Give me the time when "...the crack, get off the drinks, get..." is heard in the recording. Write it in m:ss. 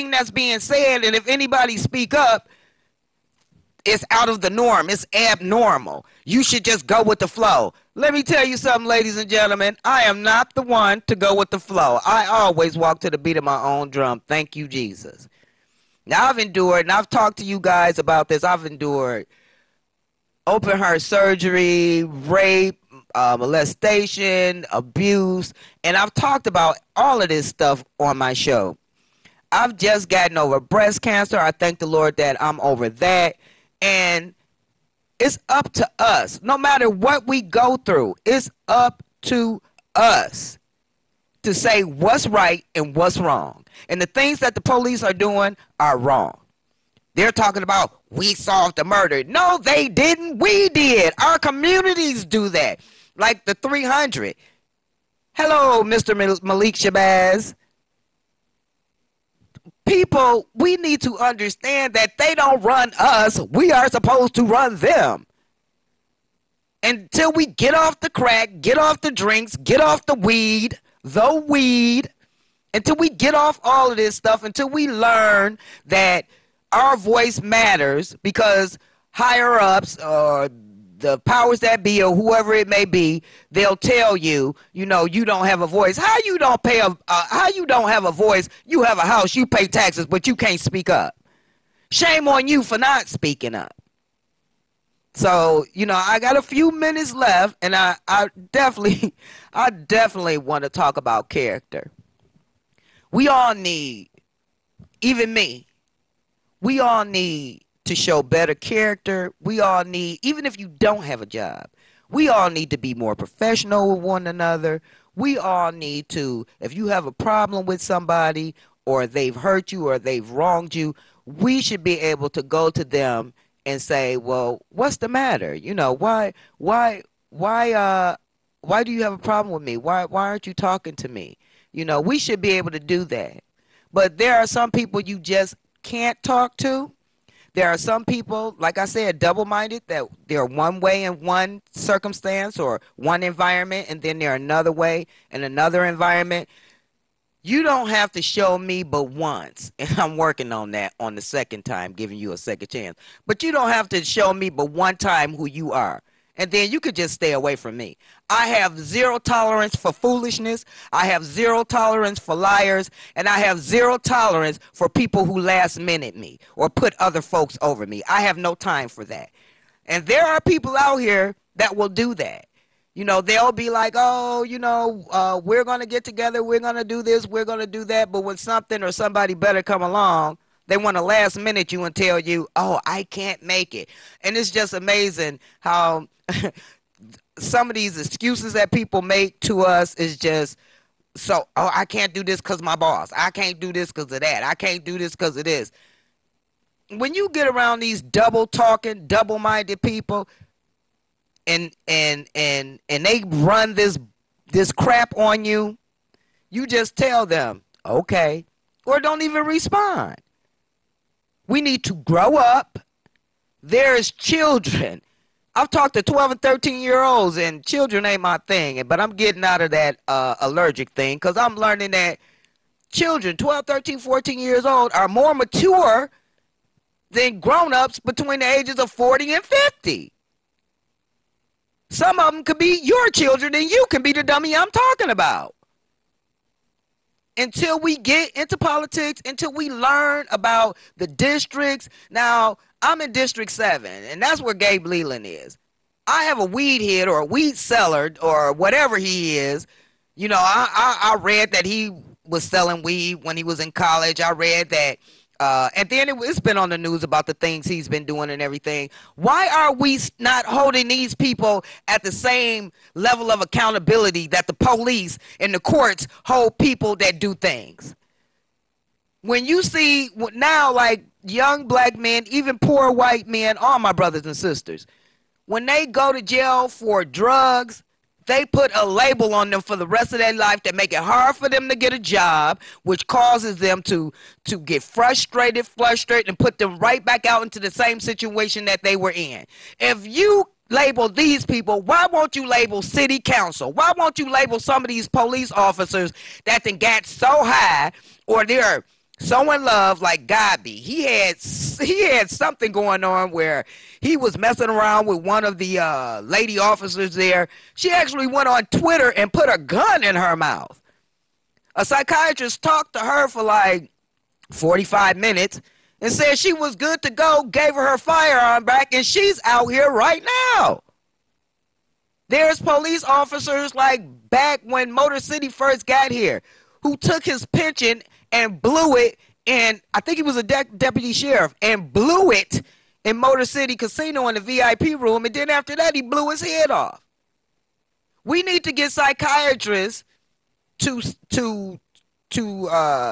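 1:07.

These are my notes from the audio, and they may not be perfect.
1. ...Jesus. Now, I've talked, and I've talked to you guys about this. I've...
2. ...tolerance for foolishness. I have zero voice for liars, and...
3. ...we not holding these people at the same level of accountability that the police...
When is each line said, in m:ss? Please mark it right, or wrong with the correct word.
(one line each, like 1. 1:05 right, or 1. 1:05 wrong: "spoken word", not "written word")
1. 0:14 wrong: "endured", not "talked"
2. 2:39 wrong: "tolerance", not "voice"
3. 4:19 right.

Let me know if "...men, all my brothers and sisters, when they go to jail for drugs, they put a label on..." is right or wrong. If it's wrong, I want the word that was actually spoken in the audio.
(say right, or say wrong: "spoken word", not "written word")
right.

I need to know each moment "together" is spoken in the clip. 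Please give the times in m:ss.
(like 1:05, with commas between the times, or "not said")
2:56.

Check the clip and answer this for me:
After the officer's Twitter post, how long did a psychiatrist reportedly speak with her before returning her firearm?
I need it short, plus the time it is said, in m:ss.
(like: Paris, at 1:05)
45 minutes, at 5:14.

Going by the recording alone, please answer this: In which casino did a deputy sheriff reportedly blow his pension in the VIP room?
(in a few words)
Motor City Casino.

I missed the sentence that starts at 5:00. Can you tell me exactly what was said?
He had he had something going on where he was messing around with one of the uh, lady officers there.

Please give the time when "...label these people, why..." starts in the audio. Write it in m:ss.
4:50.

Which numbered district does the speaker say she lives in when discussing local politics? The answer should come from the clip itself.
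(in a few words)
District 7.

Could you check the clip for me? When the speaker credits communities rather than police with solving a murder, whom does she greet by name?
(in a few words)
Malik Shabazz.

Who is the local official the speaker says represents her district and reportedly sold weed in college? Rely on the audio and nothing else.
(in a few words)
Gabe Leland.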